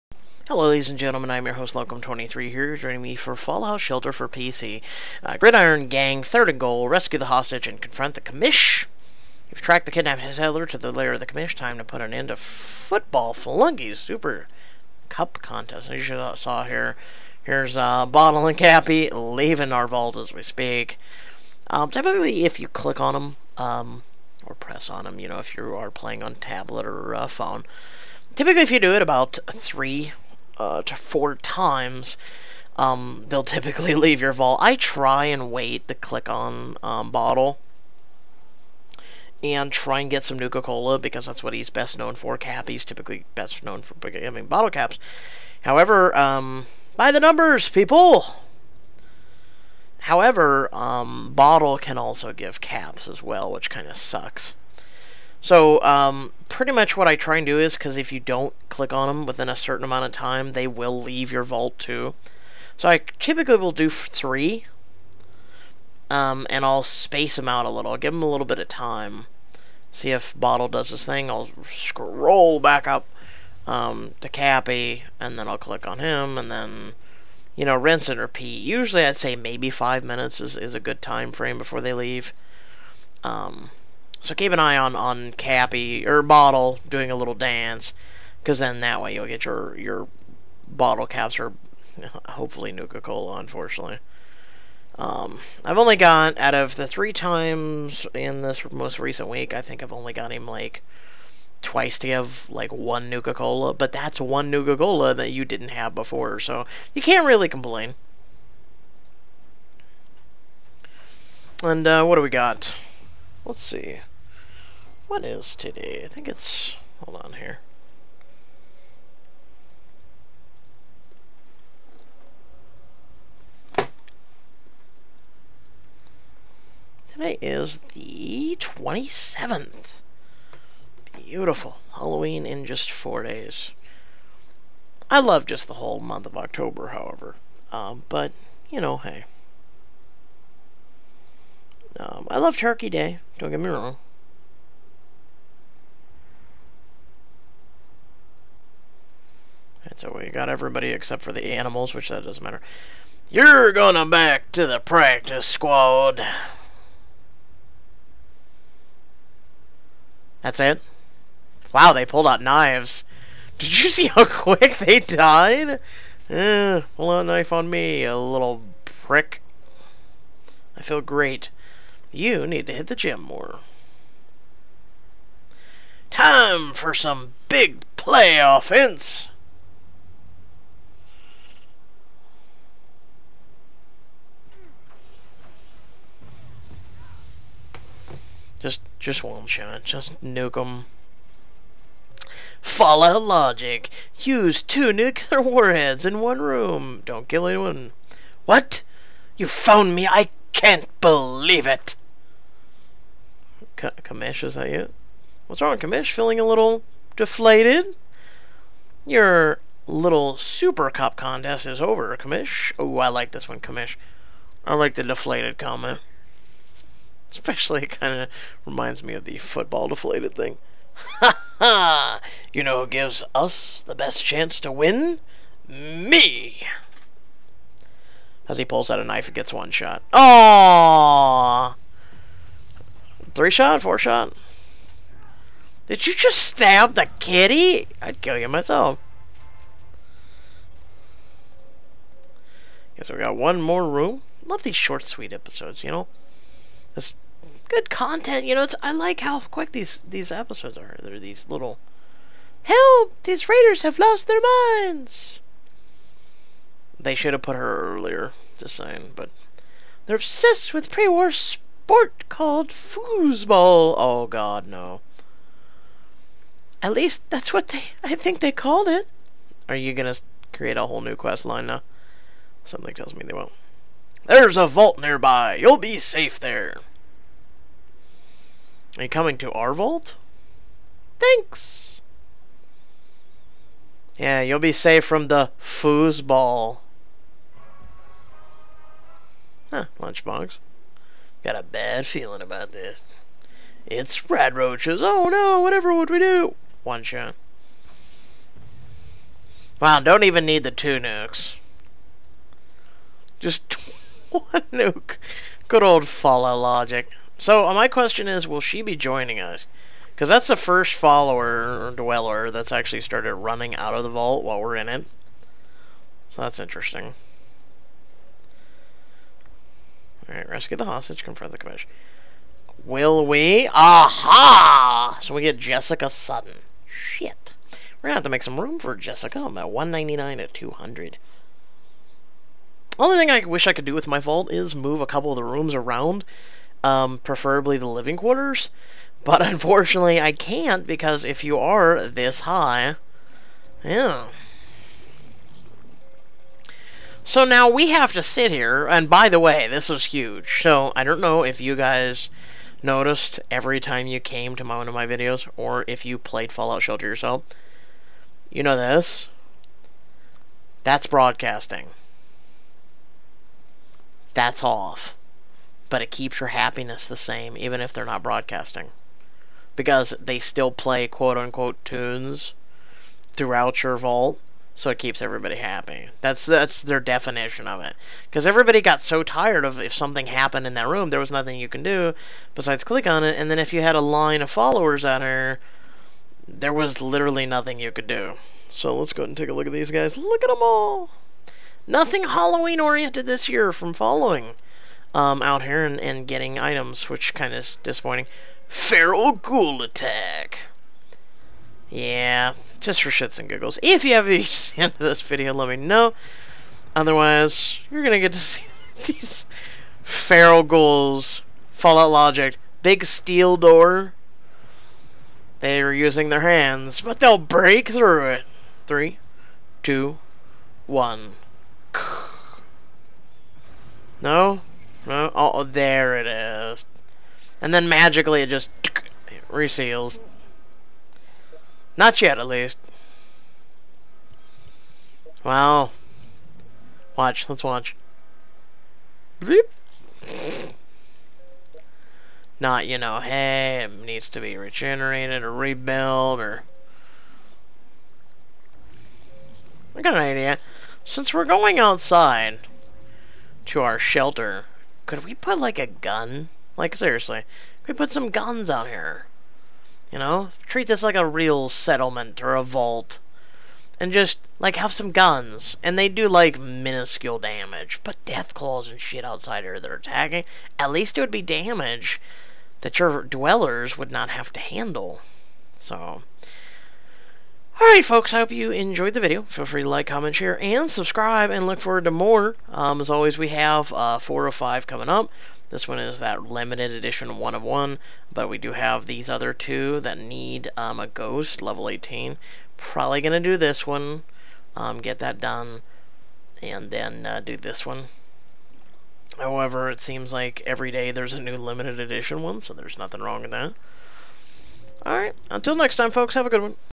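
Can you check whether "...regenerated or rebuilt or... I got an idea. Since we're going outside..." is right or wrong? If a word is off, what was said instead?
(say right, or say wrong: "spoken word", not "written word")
right.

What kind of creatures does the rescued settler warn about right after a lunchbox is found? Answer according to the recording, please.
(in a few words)
Rad roaches.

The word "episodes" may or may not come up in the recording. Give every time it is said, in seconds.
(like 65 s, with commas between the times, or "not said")
245 s, 250 s.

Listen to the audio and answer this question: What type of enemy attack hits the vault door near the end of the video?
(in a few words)
Feral Ghoul Attack.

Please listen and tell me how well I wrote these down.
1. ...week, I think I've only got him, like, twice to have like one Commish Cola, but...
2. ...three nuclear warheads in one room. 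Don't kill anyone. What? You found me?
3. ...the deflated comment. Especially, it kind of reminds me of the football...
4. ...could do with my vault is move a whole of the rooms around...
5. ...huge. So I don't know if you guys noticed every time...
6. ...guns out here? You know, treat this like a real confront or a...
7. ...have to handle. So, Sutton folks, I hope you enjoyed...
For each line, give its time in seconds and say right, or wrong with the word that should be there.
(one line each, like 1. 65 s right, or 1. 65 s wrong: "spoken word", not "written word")
1. 99 s wrong: "Nuka", not "Commish"
2. 194 s wrong: "two", not "three"
3. 214 s right
4. 333 s wrong: "couple", not "whole"
5. 350 s right
6. 458 s wrong: "settlement", not "confront"
7. 474 s wrong: "Alright", not "Sutton".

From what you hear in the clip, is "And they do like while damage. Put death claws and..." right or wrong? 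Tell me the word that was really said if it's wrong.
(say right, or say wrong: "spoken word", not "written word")
wrong: "minuscule", not "while".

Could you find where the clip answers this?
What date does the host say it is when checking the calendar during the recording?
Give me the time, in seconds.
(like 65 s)
128 s.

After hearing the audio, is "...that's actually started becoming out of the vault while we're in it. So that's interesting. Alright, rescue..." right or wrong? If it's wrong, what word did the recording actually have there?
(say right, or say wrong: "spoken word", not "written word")
wrong: "running", not "becoming".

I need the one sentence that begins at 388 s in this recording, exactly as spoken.
So let's go ahead and take a look at these guys.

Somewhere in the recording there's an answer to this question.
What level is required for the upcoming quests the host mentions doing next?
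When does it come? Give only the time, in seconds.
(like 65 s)
491 s.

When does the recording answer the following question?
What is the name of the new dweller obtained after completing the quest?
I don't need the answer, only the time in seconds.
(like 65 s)
325 s.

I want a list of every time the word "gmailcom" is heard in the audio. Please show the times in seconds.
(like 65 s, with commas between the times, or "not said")
not said.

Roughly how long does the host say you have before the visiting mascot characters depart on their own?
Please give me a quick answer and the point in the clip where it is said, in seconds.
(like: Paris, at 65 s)
5 minutes, at 79 s.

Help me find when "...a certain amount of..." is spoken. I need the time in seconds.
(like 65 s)
59 s.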